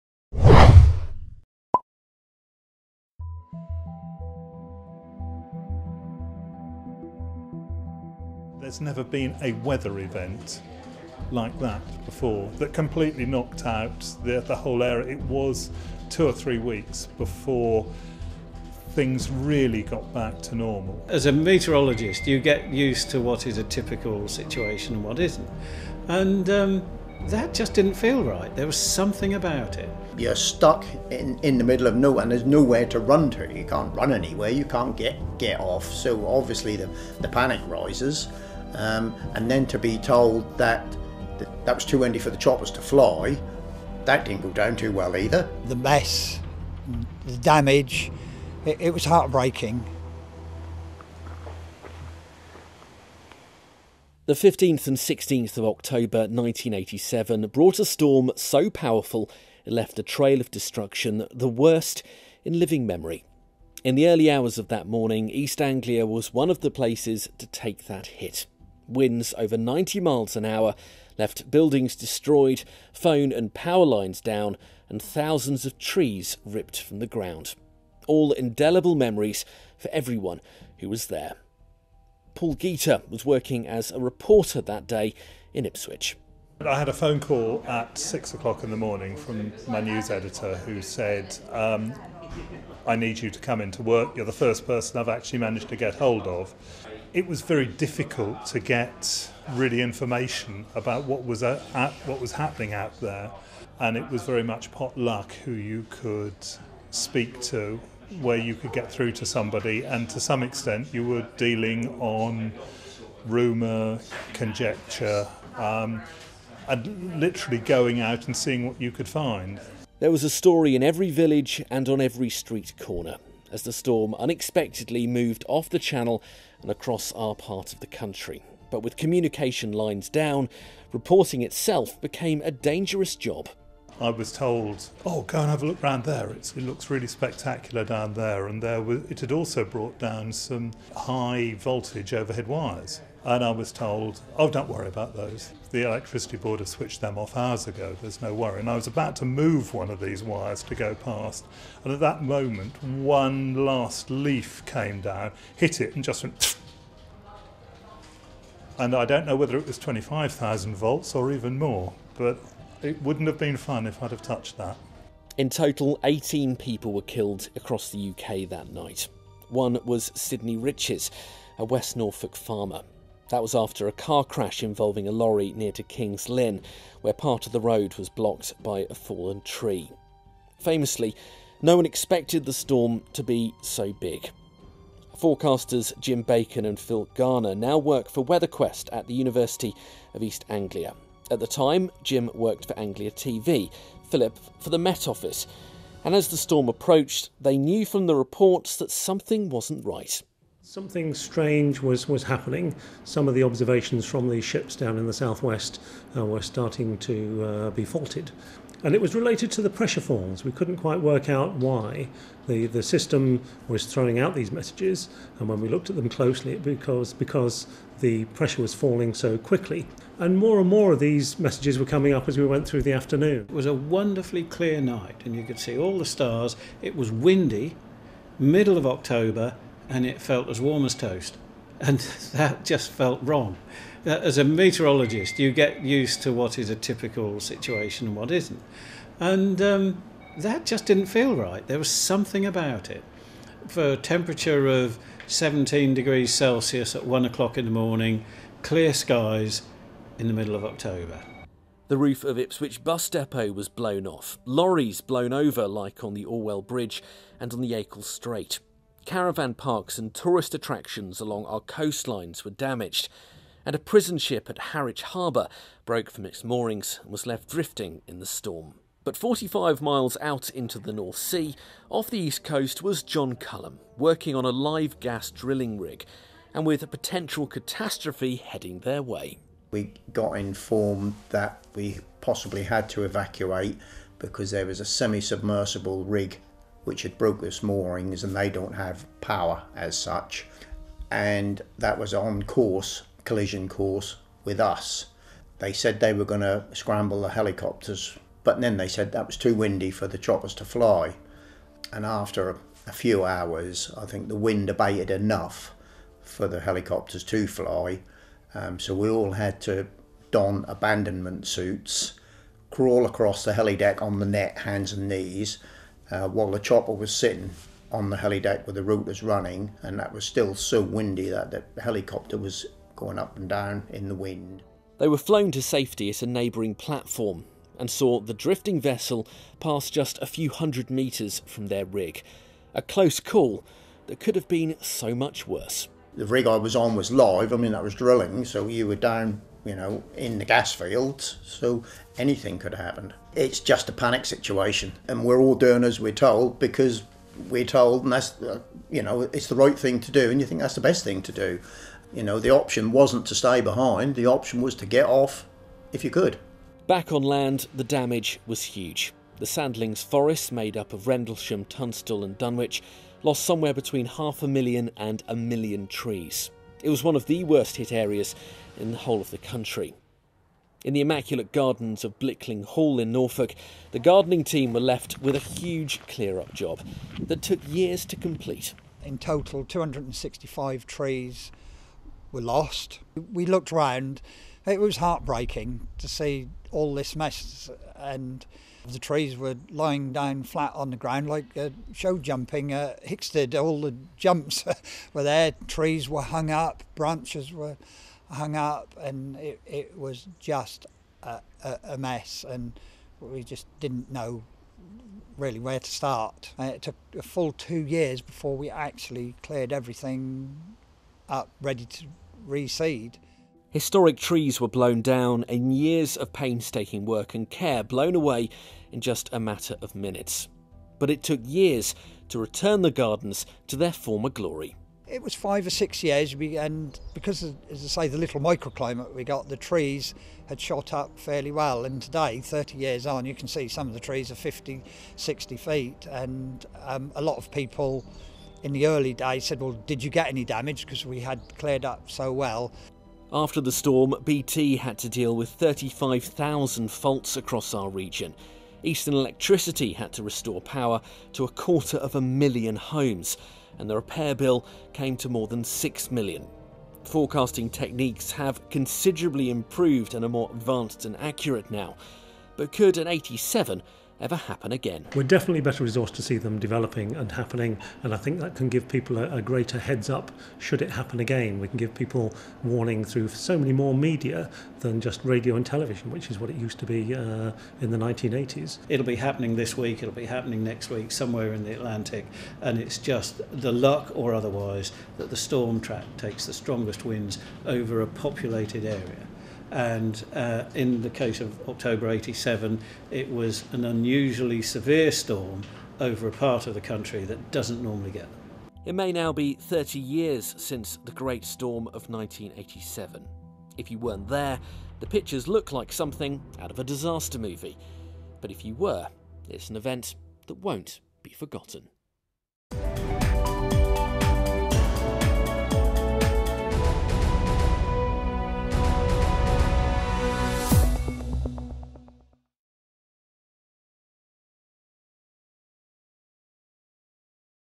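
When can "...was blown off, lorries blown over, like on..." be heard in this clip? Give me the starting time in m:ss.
4:13.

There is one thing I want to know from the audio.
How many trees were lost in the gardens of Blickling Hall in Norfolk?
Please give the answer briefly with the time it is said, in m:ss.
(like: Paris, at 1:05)
265, at 6:19.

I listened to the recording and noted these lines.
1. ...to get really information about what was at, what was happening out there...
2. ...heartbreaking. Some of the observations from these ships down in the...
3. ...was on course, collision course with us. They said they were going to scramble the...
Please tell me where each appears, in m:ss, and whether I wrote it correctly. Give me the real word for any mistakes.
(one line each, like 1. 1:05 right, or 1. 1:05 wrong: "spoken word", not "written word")
1. 1:38 right
2. 3:22 wrong: "happening", not "heartbreaking"
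3. 4:51 right.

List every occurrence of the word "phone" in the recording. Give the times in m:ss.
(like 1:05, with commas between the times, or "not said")
1:12, 1:26.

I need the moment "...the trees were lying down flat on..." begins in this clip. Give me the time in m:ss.
6:28.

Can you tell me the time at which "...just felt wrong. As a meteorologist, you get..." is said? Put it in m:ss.
3:52.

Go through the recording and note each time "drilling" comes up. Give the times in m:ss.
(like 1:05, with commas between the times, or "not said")
4:35, 5:37.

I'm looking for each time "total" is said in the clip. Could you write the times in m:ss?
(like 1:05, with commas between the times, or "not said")
2:45, 6:19.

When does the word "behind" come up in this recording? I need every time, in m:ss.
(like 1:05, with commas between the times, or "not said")
5:53.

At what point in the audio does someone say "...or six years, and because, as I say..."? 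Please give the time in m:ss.
7:05.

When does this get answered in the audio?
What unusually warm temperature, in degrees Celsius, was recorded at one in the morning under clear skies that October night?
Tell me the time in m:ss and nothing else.
4:05.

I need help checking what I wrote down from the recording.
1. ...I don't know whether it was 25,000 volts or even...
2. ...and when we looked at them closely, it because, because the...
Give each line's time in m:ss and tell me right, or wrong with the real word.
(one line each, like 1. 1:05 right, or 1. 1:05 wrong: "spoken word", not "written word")
1. 2:38 right
2. 3:35 right.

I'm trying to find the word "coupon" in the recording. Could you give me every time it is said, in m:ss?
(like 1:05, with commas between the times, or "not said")
not said.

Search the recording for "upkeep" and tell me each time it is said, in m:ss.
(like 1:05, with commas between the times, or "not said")
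not said.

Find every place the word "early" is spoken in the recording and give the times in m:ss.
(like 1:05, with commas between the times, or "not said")
1:04, 7:18.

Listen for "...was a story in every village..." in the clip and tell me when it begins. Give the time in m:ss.
2:00.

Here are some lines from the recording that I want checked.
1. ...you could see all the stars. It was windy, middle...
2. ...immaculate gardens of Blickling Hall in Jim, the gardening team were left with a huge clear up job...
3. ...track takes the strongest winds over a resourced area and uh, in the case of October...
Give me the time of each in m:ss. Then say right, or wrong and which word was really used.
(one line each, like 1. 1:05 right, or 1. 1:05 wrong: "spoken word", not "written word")
1. 3:45 right
2. 6:11 wrong: "Norfolk", not "Jim"
3. 8:05 wrong: "populated", not "resourced".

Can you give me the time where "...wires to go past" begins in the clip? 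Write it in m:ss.
2:30.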